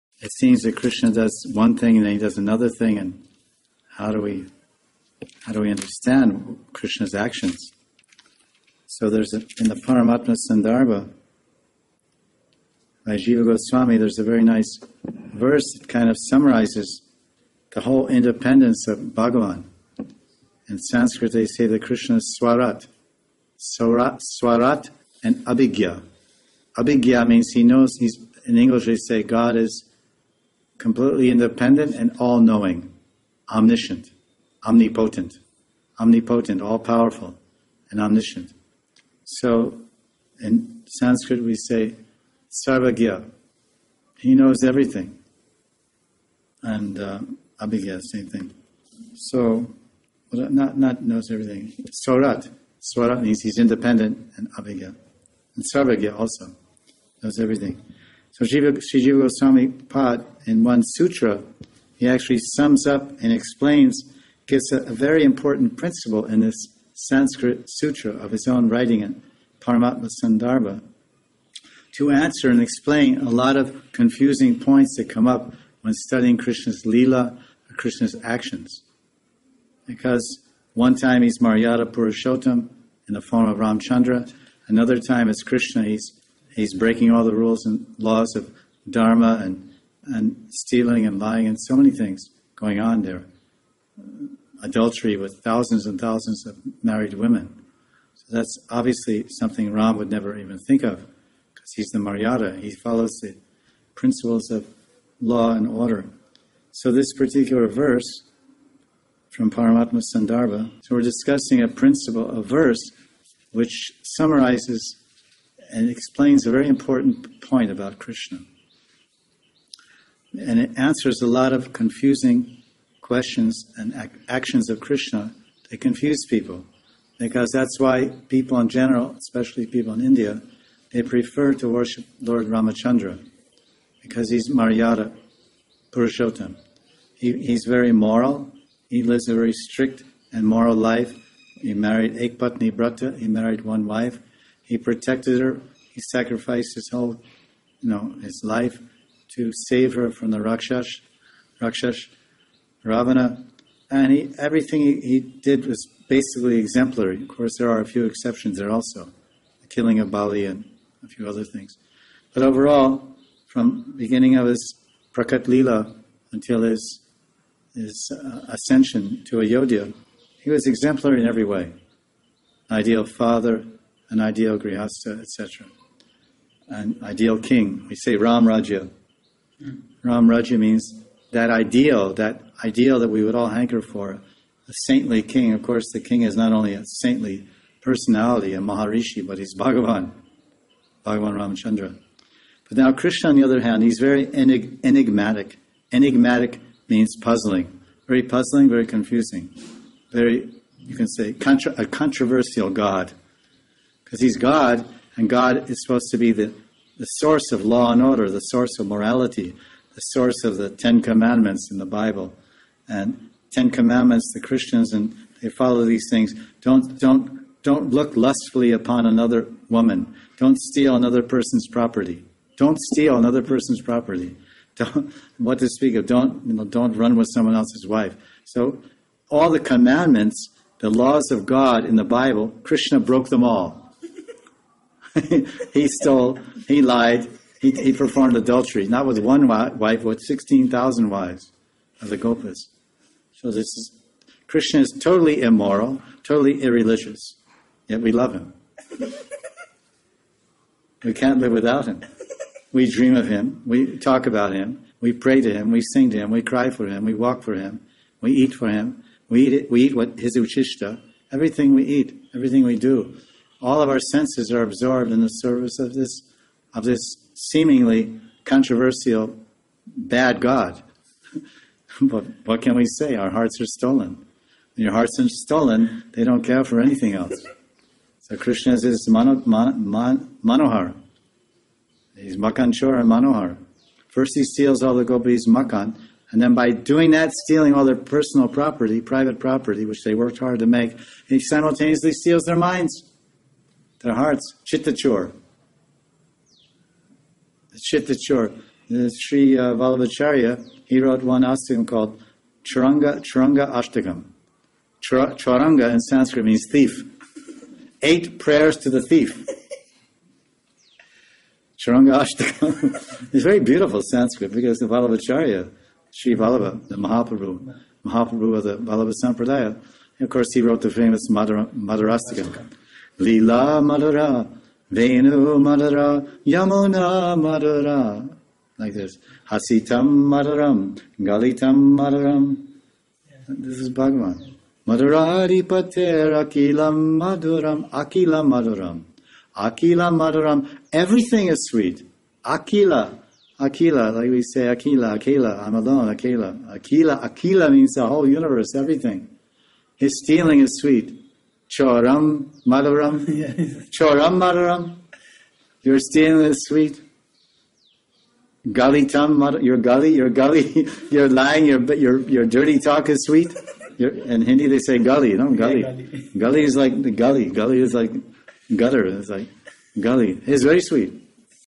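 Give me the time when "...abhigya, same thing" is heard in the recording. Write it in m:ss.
0:47.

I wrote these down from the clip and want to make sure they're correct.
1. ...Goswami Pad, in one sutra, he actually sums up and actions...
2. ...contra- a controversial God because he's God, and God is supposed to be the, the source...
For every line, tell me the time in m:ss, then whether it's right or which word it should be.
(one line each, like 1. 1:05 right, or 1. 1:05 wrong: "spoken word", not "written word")
1. 0:59 wrong: "explains", not "actions"
2. 3:21 right.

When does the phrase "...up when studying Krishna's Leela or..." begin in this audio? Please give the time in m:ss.
1:15.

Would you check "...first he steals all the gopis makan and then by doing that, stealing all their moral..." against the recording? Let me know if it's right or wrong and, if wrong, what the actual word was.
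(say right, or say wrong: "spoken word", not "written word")
wrong: "personal", not "moral".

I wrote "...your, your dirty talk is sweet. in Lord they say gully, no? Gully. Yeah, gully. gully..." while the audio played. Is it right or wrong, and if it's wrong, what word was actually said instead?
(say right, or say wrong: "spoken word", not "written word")
wrong: "Hindi", not "Lord".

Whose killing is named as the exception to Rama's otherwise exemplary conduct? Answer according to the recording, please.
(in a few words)
Bali.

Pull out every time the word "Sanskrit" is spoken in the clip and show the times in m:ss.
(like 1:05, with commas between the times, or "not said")
0:20, 0:40, 1:06, 5:06, 5:14.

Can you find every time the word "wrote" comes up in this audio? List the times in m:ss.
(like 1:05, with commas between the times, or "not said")
5:00, 5:20.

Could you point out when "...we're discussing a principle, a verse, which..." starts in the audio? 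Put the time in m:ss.
1:50.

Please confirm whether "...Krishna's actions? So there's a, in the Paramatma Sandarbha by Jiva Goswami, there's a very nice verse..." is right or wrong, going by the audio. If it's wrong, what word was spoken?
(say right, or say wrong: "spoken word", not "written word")
right.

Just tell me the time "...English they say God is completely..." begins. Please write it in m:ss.
0:28.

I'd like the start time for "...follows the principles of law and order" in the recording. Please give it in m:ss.
1:42.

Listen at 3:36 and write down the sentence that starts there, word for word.
Don't, don't, don't look lustfully upon another woman.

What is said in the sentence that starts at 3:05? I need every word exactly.
Of course, the king is not only a saintly personality, a Maharishi, but he's Bhagavan, Bhagavan Ramachandra.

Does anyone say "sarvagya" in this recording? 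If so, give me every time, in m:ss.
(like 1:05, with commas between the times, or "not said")
0:42, 0:55.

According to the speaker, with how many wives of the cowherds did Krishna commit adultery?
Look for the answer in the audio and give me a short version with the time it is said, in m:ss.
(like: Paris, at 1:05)
16,000, at 4:00.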